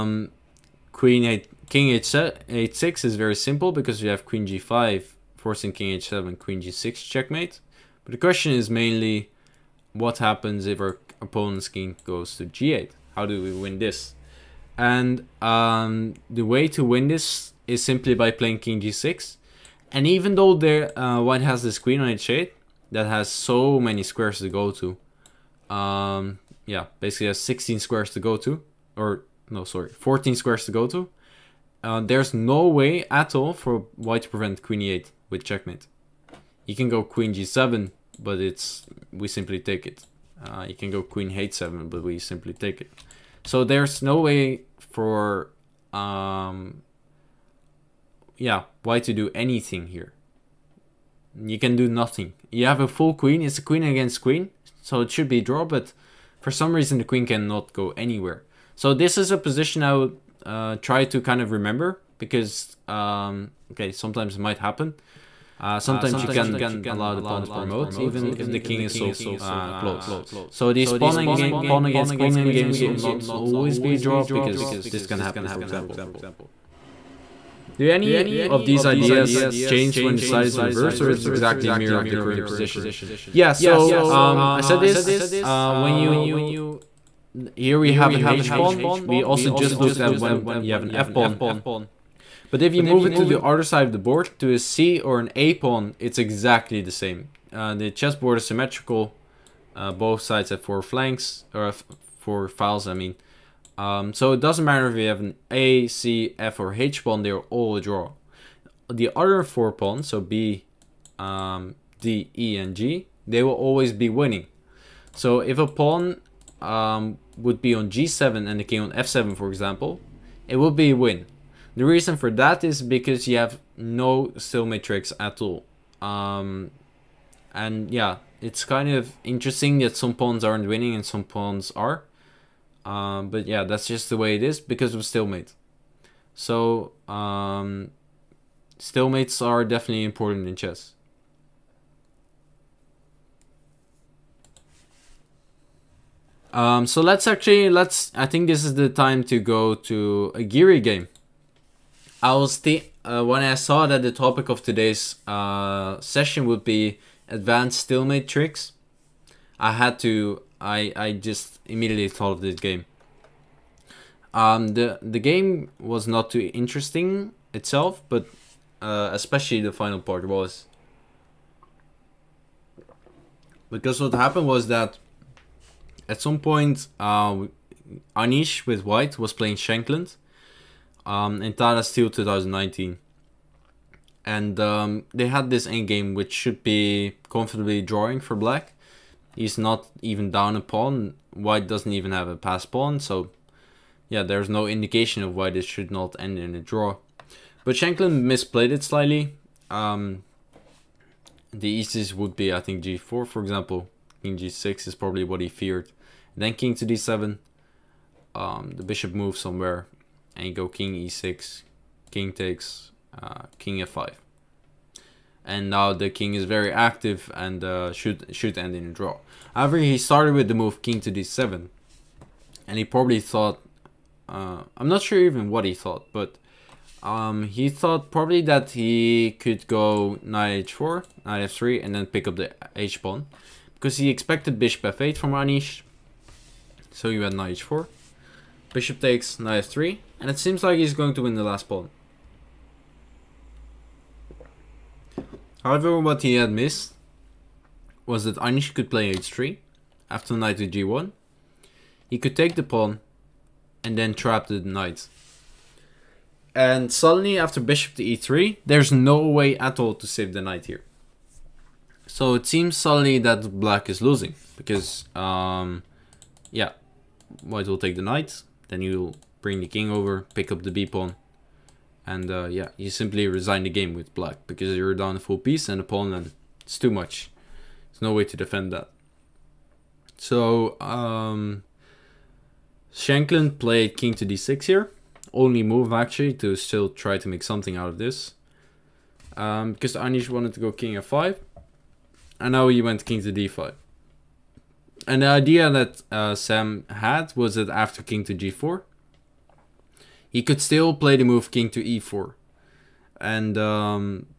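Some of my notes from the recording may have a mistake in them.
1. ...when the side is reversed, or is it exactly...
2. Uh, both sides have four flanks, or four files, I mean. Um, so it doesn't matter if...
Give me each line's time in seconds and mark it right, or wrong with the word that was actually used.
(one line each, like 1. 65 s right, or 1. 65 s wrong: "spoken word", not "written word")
1. 80 s right
2. 99 s right.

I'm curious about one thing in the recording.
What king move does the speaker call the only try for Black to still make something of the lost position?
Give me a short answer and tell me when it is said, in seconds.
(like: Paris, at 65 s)
king to d6, at 283 s.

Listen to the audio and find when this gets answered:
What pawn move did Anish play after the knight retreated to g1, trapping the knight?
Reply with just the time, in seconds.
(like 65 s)
249 s.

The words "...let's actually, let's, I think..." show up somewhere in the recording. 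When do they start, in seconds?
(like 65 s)
147 s.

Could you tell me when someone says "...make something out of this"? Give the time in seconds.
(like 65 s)
287 s.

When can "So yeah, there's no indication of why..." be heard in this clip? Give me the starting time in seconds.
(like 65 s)
193 s.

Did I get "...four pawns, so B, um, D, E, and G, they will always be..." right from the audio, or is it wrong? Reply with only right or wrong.
right.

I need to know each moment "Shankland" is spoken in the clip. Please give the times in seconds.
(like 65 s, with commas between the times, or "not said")
179 s, 197 s, 282 s.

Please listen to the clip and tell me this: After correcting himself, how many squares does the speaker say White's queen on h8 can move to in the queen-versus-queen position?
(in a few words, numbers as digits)
14.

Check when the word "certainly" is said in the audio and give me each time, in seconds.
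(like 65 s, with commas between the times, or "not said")
not said.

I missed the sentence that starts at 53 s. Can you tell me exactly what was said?
It's a queen against queen, so it should be draw, but for some reason the queen cannot go anywhere.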